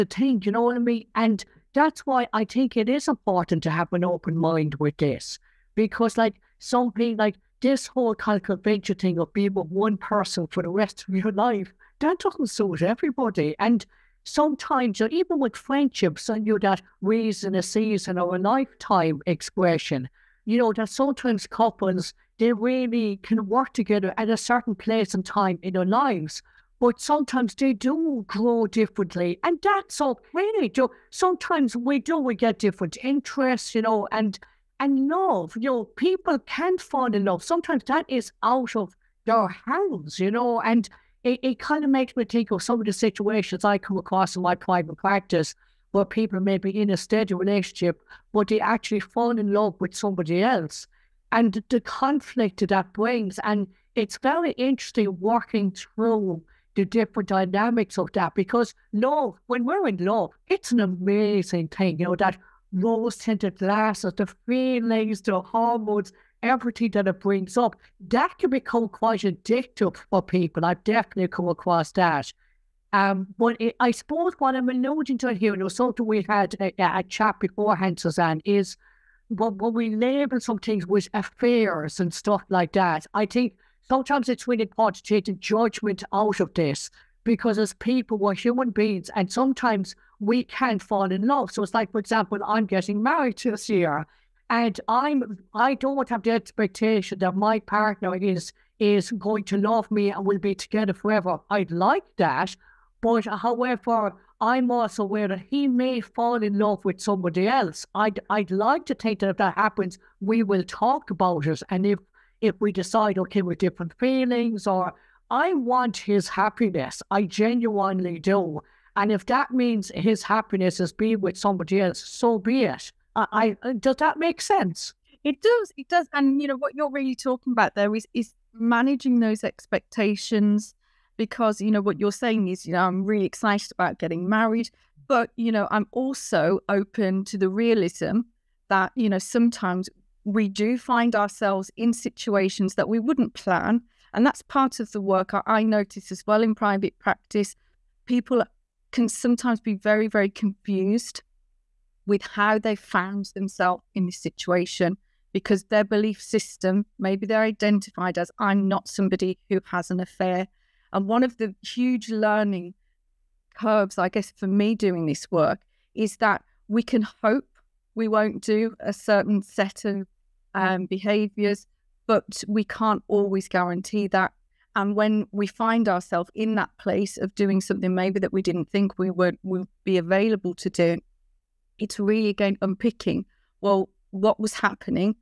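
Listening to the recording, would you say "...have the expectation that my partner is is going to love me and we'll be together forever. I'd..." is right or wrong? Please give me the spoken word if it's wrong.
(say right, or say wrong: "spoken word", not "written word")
right.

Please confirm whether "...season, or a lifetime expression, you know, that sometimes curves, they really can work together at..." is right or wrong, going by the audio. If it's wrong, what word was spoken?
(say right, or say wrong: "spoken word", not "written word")
wrong: "couples", not "curves".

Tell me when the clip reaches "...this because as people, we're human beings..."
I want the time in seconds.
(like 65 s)
86 s.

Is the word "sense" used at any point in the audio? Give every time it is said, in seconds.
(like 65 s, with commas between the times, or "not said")
124 s.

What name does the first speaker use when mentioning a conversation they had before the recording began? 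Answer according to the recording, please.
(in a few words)
Suzanne.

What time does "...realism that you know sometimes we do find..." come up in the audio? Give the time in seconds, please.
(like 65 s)
137 s.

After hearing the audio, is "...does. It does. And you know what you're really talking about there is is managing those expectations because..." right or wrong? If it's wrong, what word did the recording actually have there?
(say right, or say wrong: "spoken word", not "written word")
right.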